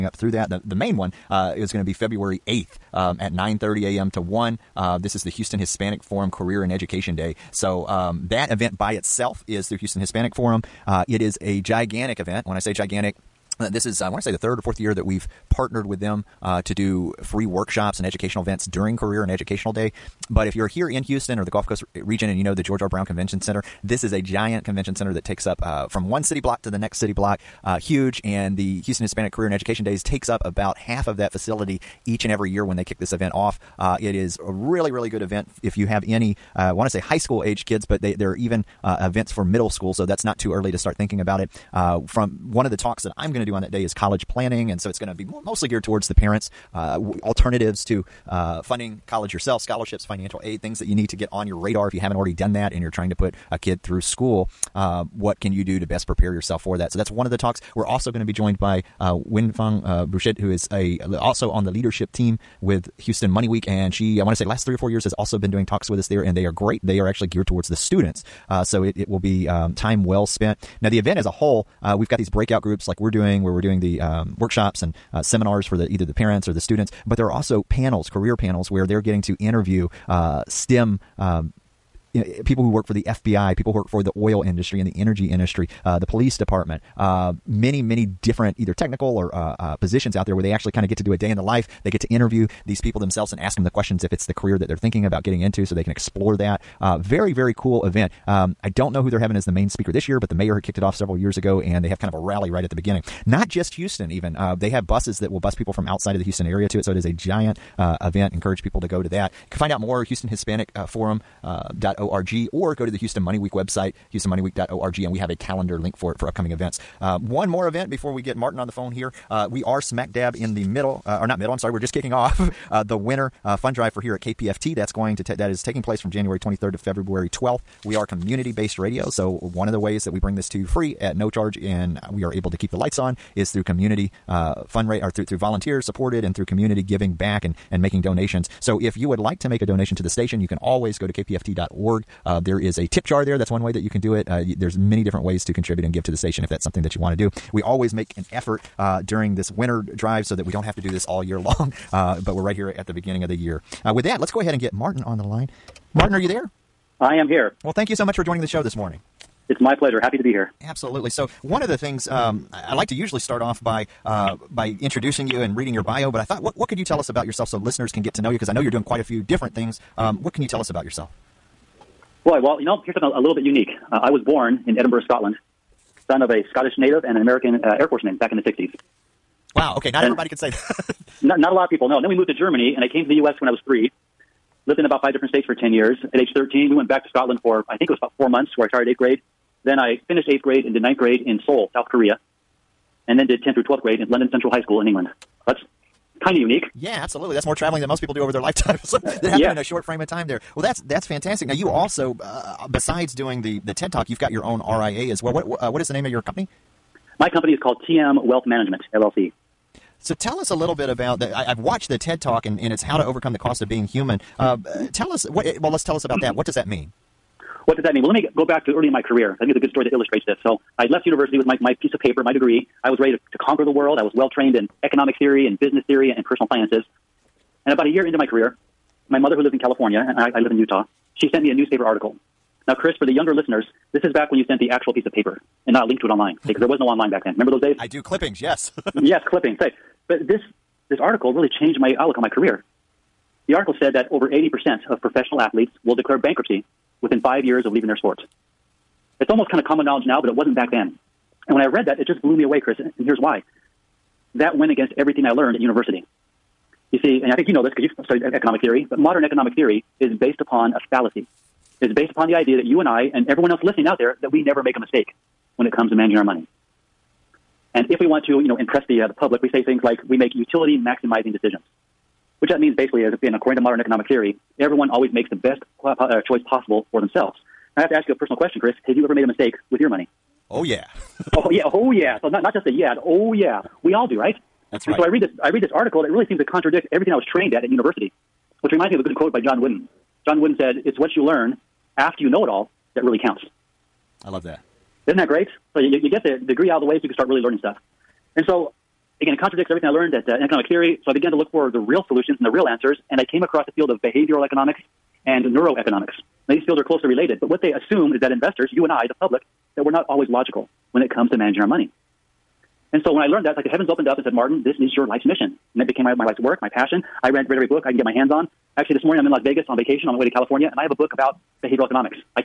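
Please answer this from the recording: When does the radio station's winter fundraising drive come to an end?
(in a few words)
February 12th.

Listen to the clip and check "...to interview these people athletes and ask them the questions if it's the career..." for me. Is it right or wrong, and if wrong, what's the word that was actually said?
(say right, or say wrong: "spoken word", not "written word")
wrong: "themselves", not "athletes".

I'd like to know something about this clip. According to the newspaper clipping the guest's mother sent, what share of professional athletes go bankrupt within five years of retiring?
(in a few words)
Over 80%.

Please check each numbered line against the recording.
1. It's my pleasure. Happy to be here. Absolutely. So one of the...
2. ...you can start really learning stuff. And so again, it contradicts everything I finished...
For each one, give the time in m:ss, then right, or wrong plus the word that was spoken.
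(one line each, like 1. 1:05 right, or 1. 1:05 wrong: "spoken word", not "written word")
1. 2:39 right
2. 4:57 wrong: "learned", not "finished".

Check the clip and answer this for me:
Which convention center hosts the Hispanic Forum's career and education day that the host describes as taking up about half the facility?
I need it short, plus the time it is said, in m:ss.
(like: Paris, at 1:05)
George R. Brown Convention Center, at 0:22.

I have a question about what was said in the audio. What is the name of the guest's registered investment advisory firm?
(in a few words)
TM Wealth Management LLC.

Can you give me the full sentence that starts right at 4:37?
Now, I have to ask you a personal question, Chris.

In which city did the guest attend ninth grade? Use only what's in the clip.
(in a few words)
Seoul, South Korea.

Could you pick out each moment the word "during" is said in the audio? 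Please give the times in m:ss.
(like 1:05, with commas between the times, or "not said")
0:18, 2:29.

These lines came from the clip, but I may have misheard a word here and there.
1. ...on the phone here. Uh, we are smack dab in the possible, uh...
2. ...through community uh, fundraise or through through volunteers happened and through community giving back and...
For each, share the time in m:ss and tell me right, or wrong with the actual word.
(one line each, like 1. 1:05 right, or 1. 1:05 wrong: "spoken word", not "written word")
1. 1:58 wrong: "middle", not "possible"
2. 2:13 wrong: "supported", not "happened".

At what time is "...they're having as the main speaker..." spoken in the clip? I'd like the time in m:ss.
1:39.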